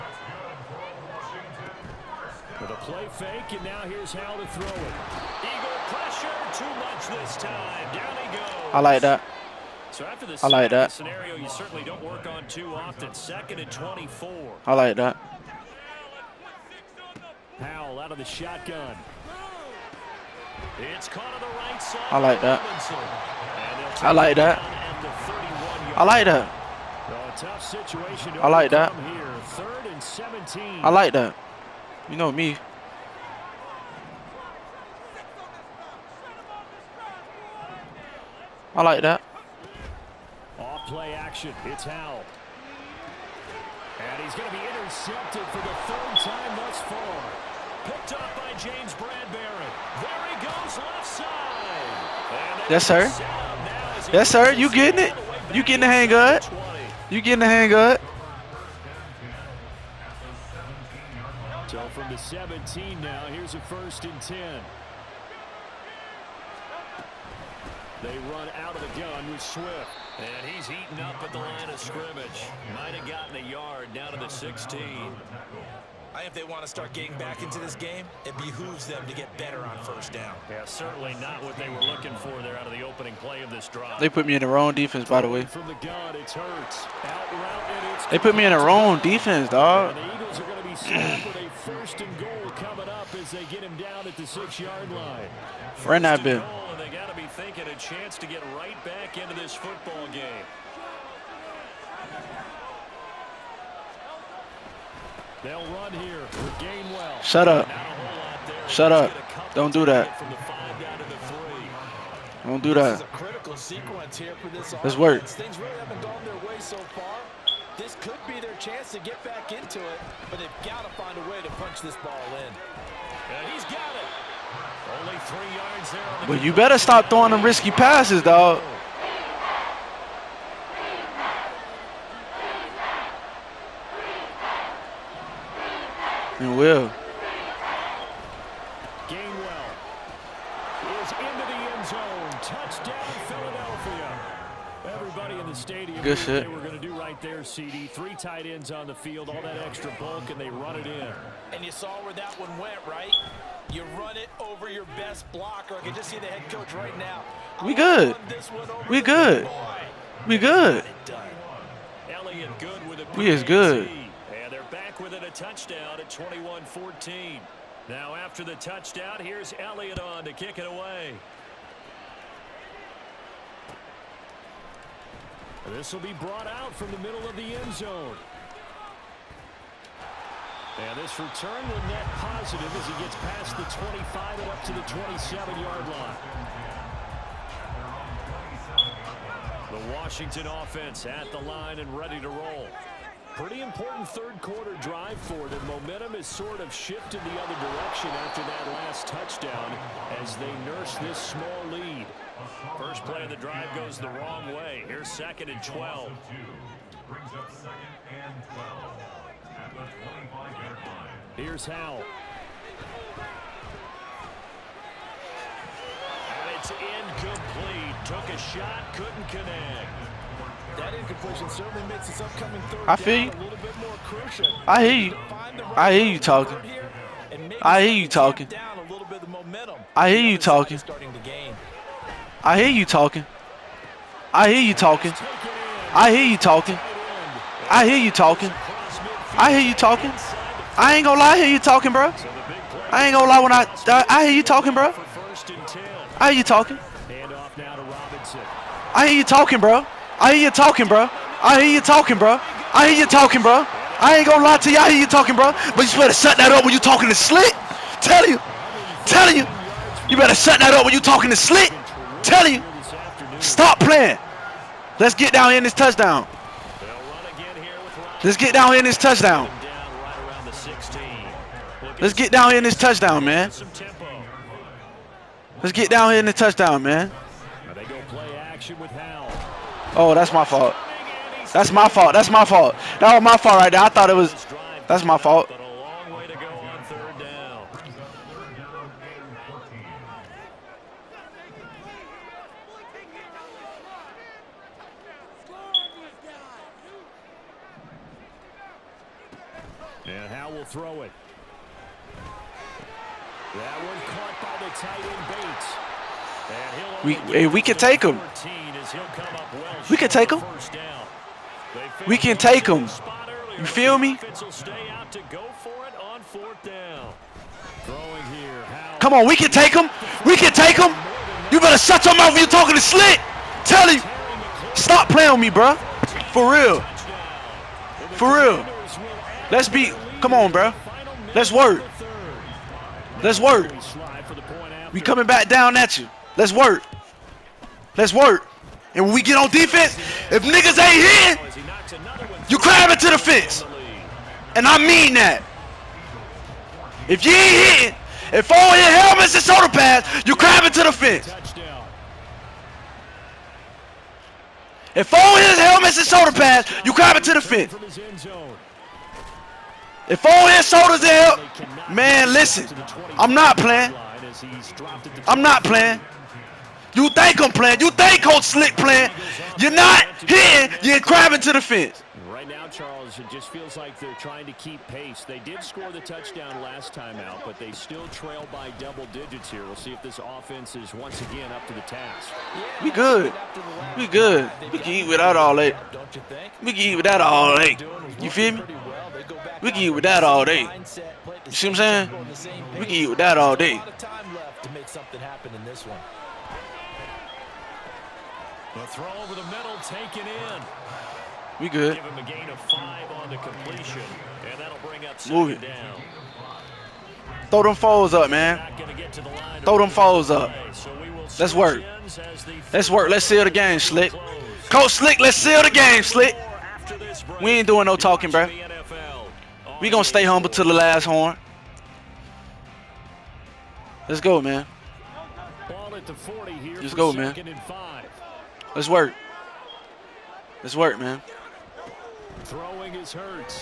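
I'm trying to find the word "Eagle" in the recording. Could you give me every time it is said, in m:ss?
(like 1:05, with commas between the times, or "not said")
0:05, 1:30.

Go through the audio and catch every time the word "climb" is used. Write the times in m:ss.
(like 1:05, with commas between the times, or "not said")
5:42, 5:50, 5:56.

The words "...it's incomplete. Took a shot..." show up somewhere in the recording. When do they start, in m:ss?
3:36.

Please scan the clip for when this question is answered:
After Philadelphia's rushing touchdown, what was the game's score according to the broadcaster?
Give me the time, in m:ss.
2:46.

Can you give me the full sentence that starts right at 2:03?
And he's got but you better stop throwing them risky passes, dog.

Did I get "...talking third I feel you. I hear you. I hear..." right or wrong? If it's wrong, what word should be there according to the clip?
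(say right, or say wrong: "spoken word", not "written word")
wrong: "upcoming", not "talking".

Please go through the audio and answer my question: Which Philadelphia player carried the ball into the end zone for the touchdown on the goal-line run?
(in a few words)
Gainwell.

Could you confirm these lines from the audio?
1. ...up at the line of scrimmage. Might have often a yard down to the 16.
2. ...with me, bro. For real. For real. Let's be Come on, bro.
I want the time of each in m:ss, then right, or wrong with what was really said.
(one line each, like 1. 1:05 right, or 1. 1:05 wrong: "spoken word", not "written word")
1. 1:11 wrong: "gotten", not "often"
2. 5:25 right.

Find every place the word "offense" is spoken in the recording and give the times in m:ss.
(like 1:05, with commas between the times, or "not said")
3:10, 6:20.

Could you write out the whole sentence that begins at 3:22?
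First play of the drive goes the wrong way.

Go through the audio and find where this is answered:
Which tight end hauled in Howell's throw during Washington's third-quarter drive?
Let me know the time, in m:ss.
5:07.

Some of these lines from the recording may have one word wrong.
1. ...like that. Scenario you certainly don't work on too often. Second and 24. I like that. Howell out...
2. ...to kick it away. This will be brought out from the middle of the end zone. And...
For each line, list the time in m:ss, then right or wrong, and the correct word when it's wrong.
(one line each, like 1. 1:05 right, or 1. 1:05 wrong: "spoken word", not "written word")
1. 0:10 right
2. 2:50 right.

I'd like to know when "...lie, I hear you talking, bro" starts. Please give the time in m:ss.
4:01.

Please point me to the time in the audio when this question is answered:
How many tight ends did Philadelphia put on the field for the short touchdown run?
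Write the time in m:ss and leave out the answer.
2:27.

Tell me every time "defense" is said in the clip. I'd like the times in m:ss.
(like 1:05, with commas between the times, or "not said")
1:24, 1:28, 5:39.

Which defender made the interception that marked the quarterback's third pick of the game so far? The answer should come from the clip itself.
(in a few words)
James Bradberry.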